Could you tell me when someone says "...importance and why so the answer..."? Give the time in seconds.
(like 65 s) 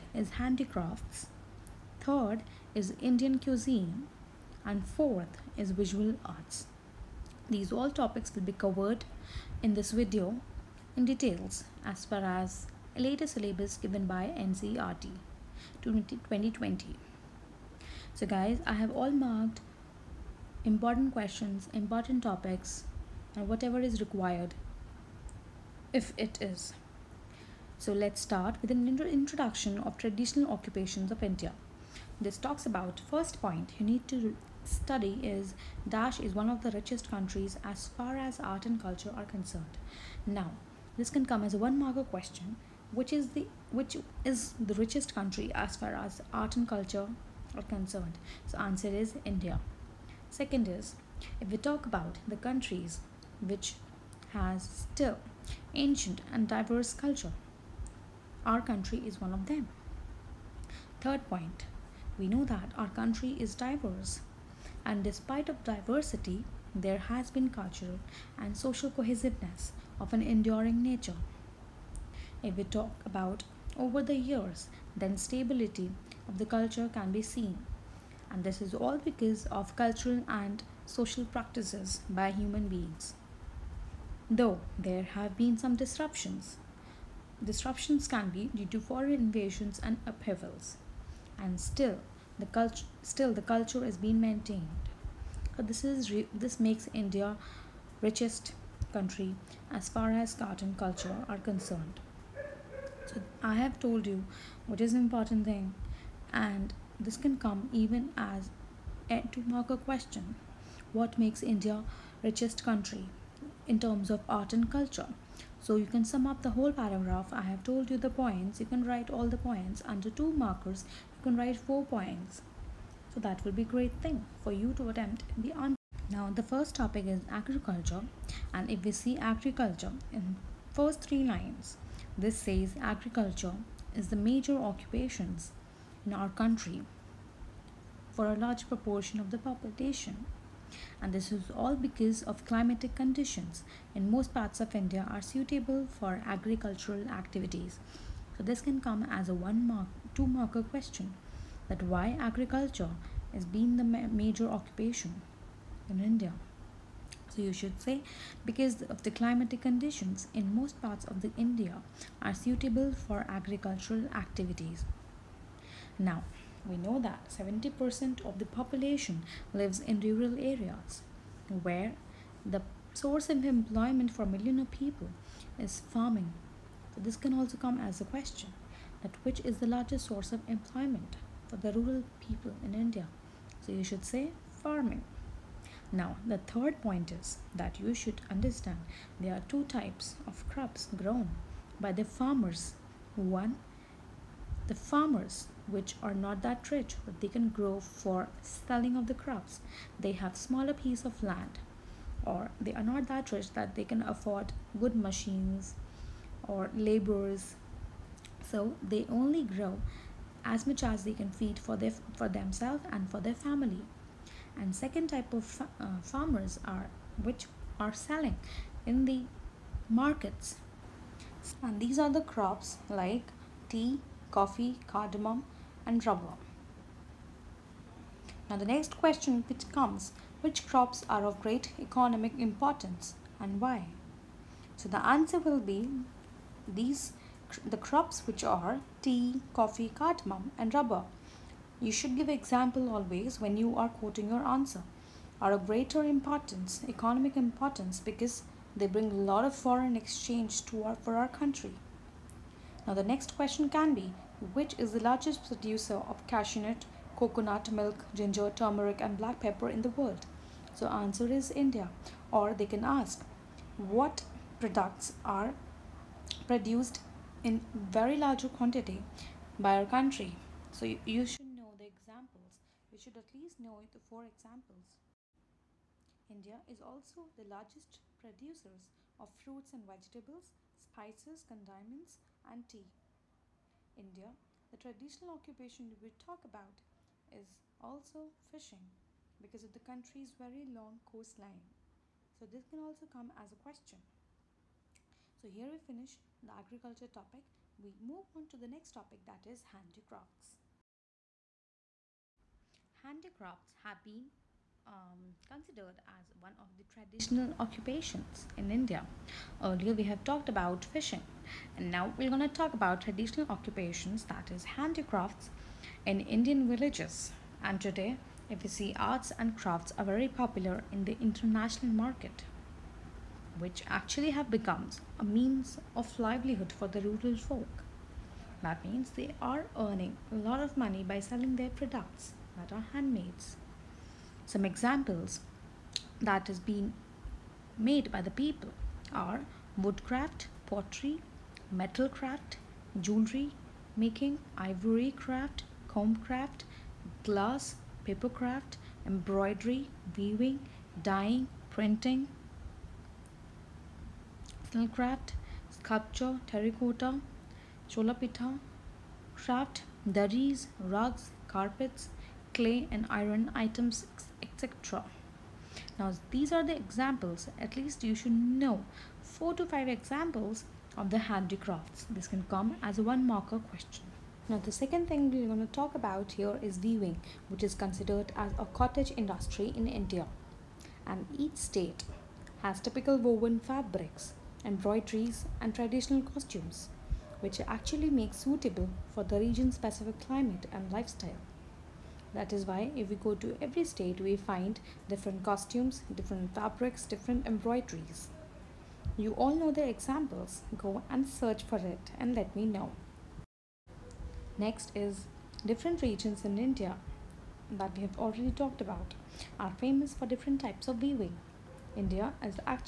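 232 s.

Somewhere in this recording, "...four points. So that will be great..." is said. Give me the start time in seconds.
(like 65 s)
121 s.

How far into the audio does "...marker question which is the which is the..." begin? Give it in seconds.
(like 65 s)
41 s.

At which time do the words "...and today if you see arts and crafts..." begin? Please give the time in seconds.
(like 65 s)
317 s.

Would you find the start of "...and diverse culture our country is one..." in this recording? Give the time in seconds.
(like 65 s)
56 s.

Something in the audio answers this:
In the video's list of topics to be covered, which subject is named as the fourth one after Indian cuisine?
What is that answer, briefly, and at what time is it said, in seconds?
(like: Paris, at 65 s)
Visual arts, at 5 s.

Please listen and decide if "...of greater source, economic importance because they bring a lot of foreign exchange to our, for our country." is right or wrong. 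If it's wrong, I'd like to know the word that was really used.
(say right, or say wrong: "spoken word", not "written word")
wrong: "importance", not "source".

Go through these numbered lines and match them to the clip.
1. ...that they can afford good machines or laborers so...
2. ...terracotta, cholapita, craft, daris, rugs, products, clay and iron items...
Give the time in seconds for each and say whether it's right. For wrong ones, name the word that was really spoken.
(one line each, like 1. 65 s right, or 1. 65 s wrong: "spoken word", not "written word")
1. 203 s right
2. 356 s wrong: "carpets", not "products".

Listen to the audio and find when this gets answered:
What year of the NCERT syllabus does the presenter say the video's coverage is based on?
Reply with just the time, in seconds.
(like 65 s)
15 s.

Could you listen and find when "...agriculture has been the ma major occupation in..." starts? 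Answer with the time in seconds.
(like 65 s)
152 s.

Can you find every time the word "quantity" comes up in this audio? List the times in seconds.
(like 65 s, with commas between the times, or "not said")
268 s.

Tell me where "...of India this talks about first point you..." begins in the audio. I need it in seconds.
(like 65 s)
31 s.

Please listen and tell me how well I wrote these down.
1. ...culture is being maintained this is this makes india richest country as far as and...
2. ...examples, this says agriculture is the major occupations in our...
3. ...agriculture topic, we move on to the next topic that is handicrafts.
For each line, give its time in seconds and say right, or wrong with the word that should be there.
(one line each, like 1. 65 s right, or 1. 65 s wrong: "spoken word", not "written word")
1. 93 s right
2. 131 s wrong: "lines", not "examples"
3. 296 s right.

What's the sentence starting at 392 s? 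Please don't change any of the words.
That is why if we go to every state, we find different costumes, different fabrics, different embroideries.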